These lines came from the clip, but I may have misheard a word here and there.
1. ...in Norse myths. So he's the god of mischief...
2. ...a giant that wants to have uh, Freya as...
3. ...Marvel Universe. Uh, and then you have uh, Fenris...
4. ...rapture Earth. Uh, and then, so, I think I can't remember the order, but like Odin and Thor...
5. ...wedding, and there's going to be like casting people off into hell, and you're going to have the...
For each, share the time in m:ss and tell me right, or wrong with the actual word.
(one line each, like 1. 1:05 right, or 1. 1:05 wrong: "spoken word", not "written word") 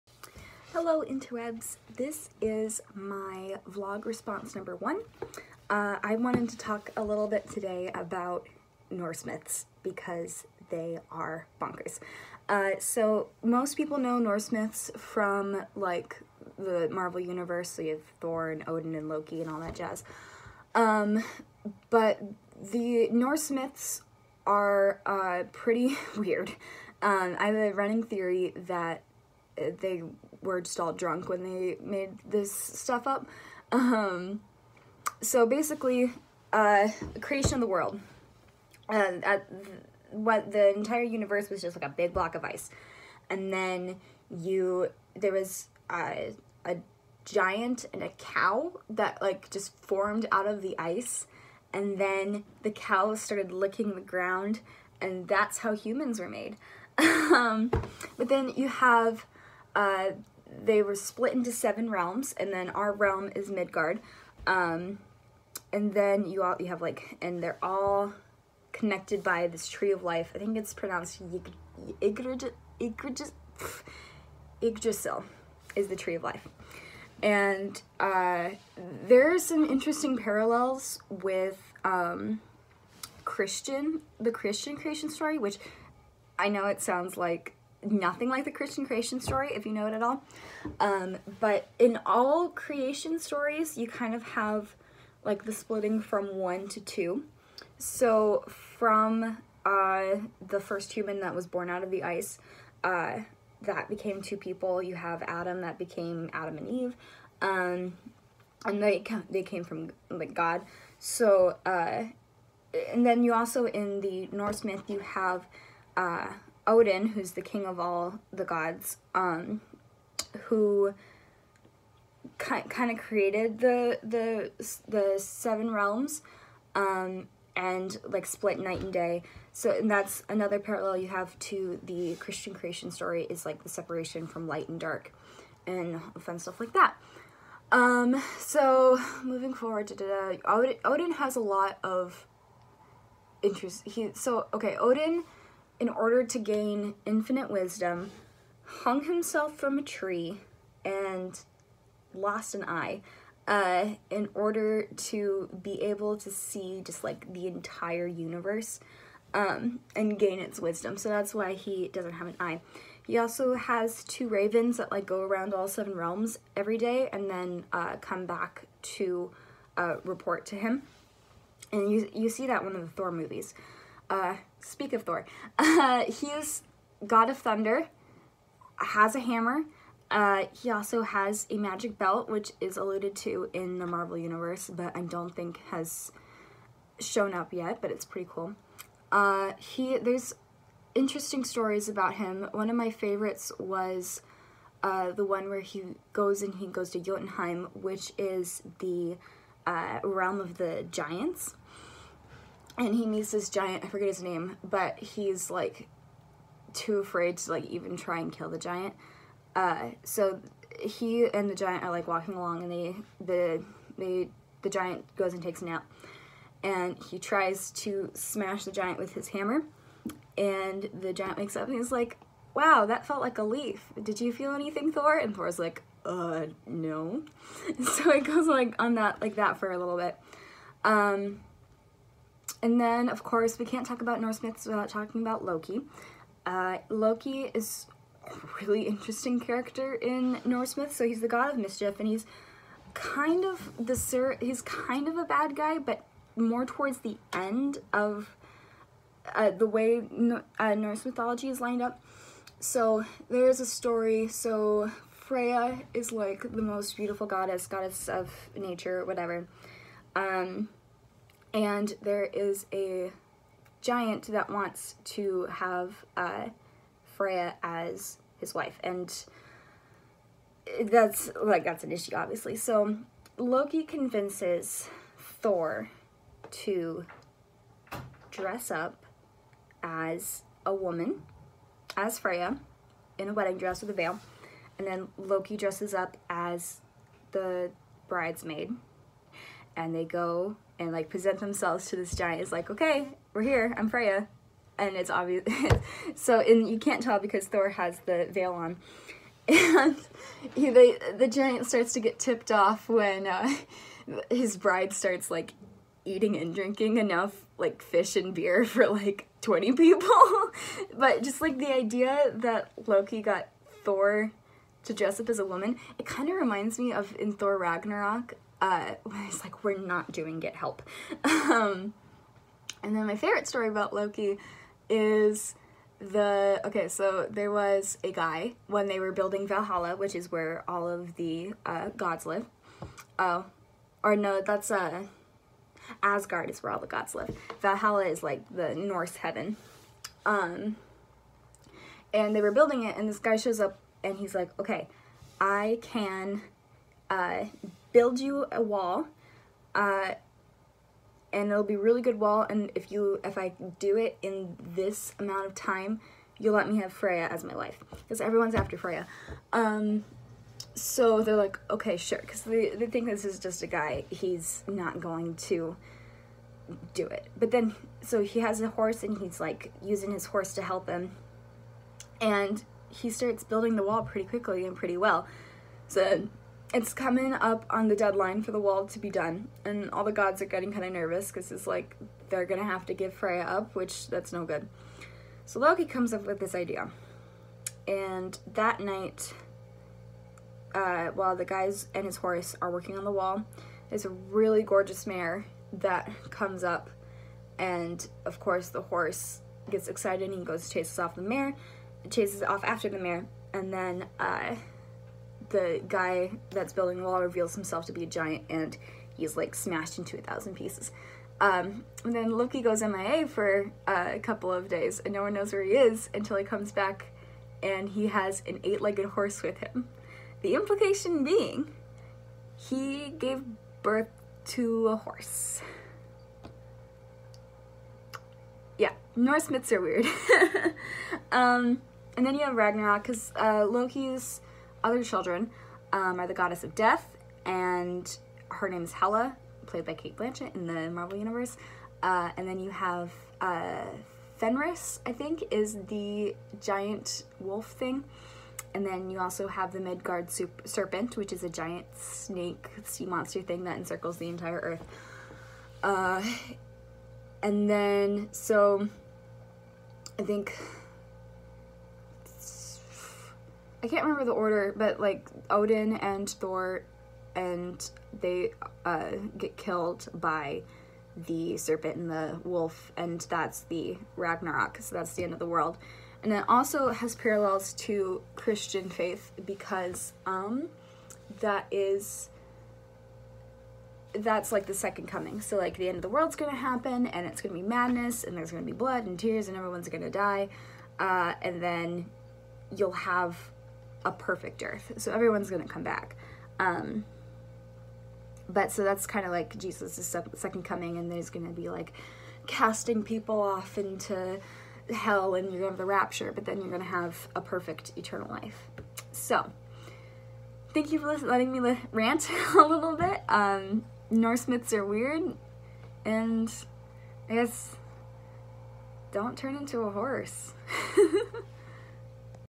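1. 3:59 right
2. 4:22 right
3. 7:20 right
4. 7:34 wrong: "entire", not "rapture"
5. 8:20 wrong: "coming", not "wedding".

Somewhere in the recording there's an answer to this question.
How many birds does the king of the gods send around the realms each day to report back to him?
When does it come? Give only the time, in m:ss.
2:44.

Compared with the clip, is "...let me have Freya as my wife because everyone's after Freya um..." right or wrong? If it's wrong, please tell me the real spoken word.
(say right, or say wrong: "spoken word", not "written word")
right.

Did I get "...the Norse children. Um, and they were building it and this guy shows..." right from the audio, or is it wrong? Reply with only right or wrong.
wrong.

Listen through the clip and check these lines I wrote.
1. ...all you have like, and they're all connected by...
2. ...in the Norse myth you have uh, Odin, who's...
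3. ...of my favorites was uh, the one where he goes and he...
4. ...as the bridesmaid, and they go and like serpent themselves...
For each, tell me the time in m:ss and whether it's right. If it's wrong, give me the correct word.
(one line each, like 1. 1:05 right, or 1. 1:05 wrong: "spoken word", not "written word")
1. 1:06 right
2. 1:53 right
3. 3:12 right
4. 4:46 wrong: "present", not "serpent".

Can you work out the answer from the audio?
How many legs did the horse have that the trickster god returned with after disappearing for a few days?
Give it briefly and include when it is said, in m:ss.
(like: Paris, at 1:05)
8, at 6:58.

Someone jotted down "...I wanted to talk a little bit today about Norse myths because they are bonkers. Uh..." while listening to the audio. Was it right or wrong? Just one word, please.
right.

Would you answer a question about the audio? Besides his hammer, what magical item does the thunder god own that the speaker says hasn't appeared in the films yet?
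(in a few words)
magic belt.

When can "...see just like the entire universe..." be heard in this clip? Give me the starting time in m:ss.
2:36.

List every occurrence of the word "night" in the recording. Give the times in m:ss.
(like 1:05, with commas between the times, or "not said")
2:08, 6:28.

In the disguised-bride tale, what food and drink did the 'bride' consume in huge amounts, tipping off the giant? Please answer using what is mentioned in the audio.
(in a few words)
fish and beer.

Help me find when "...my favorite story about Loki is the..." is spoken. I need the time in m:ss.
5:23.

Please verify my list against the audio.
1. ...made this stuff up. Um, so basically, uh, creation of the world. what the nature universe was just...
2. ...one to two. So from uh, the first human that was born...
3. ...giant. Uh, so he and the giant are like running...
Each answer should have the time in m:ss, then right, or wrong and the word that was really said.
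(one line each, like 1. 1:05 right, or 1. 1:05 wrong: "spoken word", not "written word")
1. 0:31 wrong: "entire", not "nature"
2. 1:36 right
3. 3:28 wrong: "walking", not "running".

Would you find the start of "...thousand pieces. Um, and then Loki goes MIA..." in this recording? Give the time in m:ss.
6:50.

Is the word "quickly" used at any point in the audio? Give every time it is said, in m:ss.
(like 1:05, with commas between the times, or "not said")
6:14.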